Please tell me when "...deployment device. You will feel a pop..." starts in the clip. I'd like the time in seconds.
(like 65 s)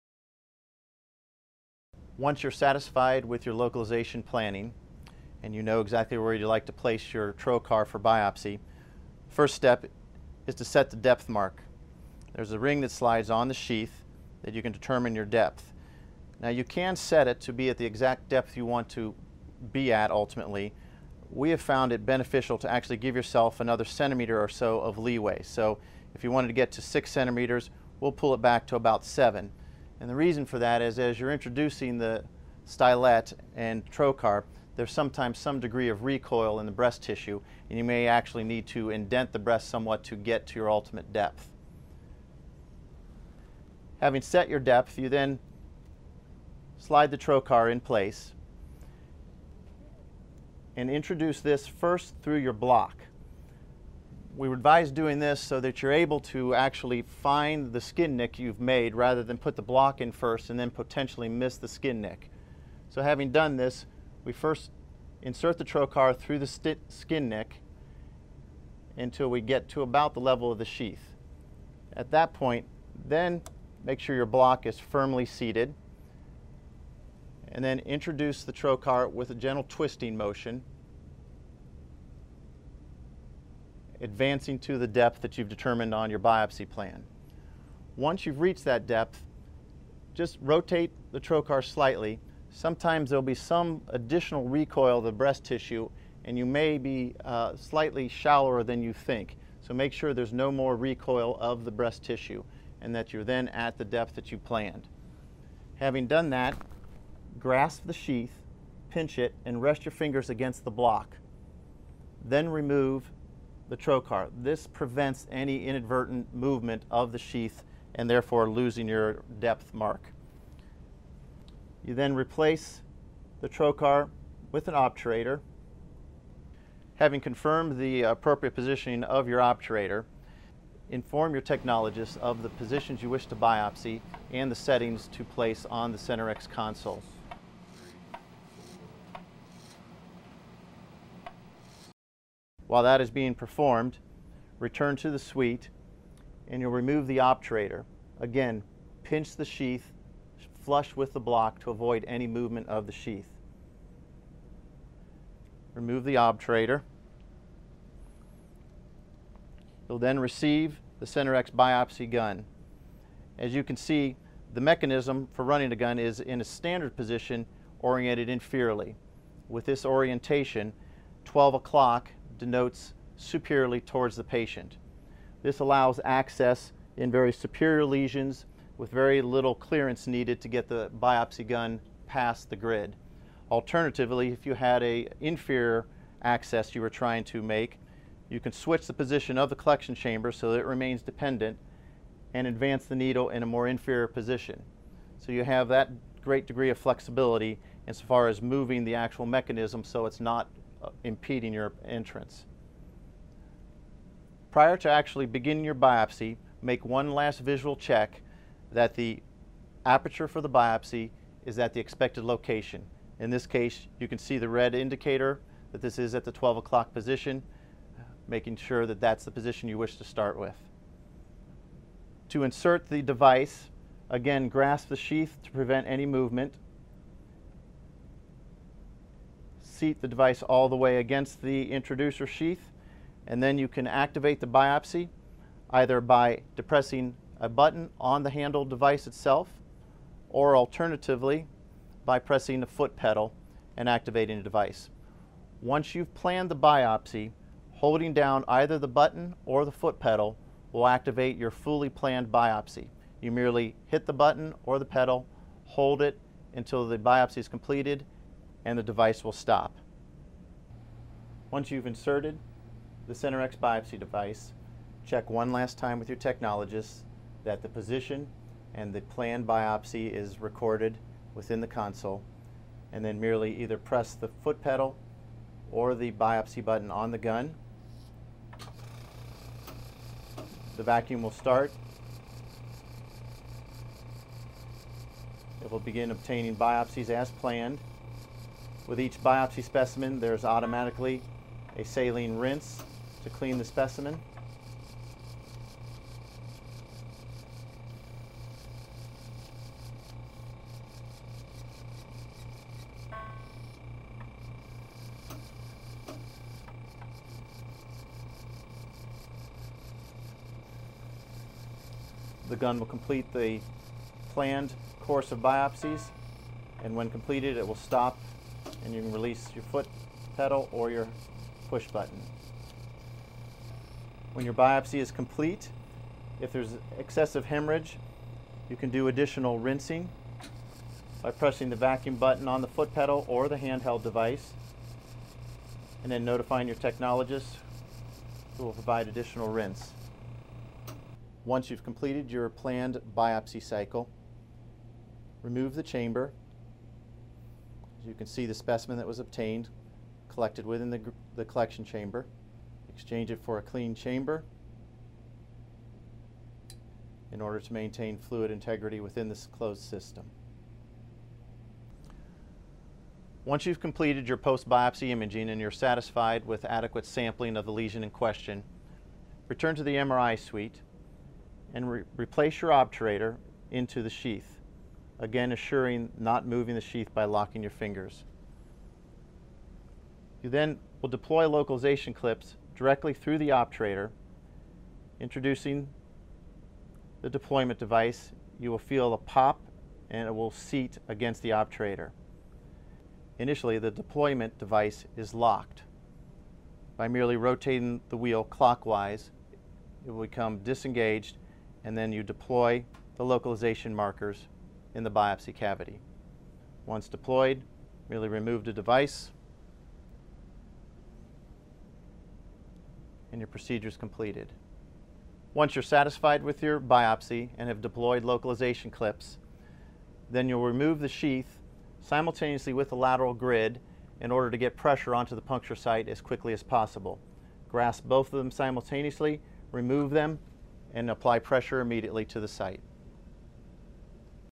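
387 s.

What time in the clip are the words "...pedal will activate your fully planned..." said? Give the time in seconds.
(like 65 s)
249 s.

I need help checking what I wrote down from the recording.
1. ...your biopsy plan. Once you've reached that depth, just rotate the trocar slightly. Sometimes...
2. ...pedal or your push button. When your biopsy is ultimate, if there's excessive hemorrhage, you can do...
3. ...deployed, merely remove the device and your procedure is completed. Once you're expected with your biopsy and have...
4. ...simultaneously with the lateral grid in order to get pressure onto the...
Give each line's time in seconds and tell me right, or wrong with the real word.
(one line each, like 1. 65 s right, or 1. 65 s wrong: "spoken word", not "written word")
1. 86 s right
2. 320 s wrong: "complete", not "ultimate"
3. 407 s wrong: "satisfied", not "expected"
4. 422 s right.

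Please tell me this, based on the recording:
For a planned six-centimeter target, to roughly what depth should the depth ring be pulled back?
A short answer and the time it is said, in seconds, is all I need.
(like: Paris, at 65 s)
7, at 29 s.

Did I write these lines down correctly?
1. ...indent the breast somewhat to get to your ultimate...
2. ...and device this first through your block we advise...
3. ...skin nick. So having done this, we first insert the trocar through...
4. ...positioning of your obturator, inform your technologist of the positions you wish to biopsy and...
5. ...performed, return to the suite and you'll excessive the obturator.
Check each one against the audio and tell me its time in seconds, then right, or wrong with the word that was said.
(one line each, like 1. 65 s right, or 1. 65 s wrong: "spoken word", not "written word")
1. 38 s right
2. 50 s wrong: "introduce", not "device"
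3. 61 s right
4. 128 s right
5. 143 s wrong: "remove", not "excessive".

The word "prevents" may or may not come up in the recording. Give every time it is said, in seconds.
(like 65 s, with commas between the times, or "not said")
114 s, 225 s.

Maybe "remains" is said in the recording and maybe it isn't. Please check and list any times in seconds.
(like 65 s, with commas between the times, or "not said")
190 s.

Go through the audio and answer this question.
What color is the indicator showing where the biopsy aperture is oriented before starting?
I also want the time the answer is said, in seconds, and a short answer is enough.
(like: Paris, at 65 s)
red, at 214 s.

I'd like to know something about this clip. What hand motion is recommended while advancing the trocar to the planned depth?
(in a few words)
gentle twisting motion.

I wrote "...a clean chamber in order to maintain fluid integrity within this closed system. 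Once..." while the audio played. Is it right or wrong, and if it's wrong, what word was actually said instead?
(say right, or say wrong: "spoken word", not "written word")
right.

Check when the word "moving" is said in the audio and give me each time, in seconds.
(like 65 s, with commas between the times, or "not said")
198 s, 376 s.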